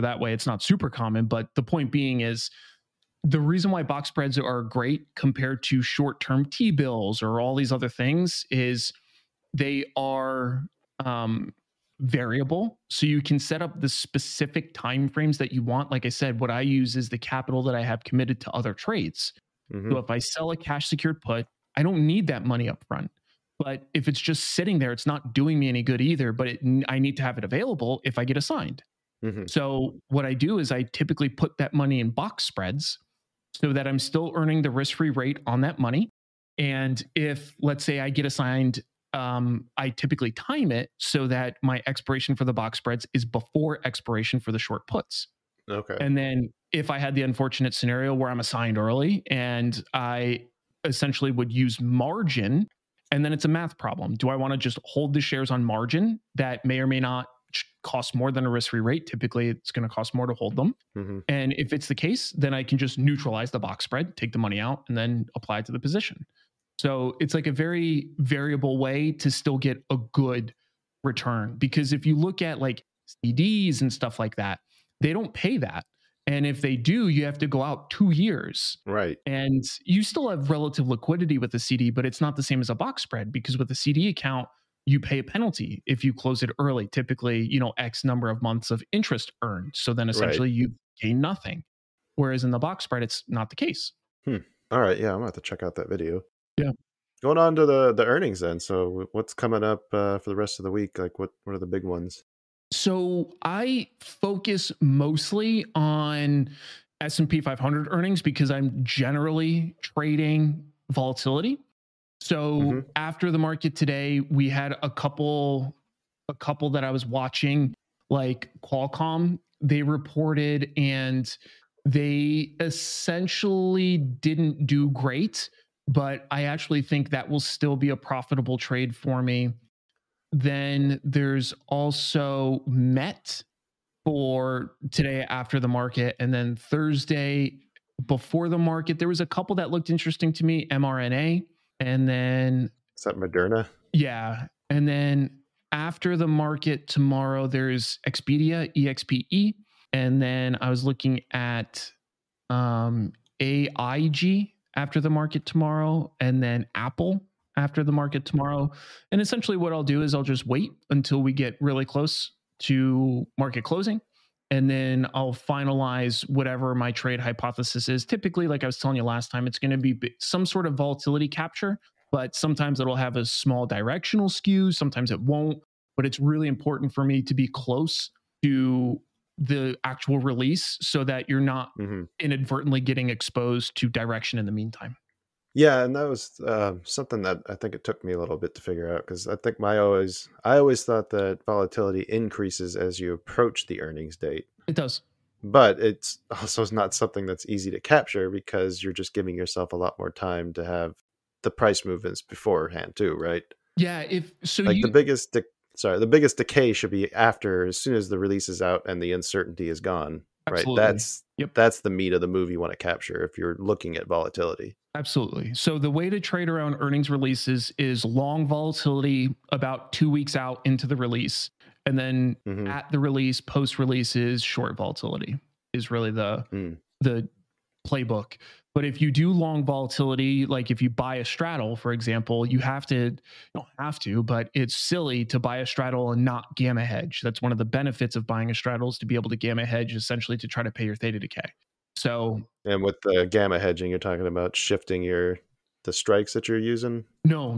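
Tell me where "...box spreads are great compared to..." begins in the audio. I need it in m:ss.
0:03.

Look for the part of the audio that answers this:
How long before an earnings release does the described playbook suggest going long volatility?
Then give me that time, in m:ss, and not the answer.
3:39.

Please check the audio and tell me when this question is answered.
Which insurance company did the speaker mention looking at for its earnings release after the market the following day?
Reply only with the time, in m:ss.
2:33.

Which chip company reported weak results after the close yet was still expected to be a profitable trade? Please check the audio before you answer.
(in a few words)
Qualcomm.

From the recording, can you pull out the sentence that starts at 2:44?
And then I'll finalize whatever my trade hypothesis is.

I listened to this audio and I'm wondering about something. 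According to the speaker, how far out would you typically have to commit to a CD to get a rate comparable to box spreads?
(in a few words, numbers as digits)
2 years.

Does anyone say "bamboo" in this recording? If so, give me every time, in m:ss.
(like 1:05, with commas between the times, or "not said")
not said.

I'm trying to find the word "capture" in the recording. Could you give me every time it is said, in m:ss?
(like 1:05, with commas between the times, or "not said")
2:51, 3:17, 3:32.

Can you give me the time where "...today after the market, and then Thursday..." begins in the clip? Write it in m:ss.
2:14.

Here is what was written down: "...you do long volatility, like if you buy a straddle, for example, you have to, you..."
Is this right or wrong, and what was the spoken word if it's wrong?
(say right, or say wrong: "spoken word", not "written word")
right.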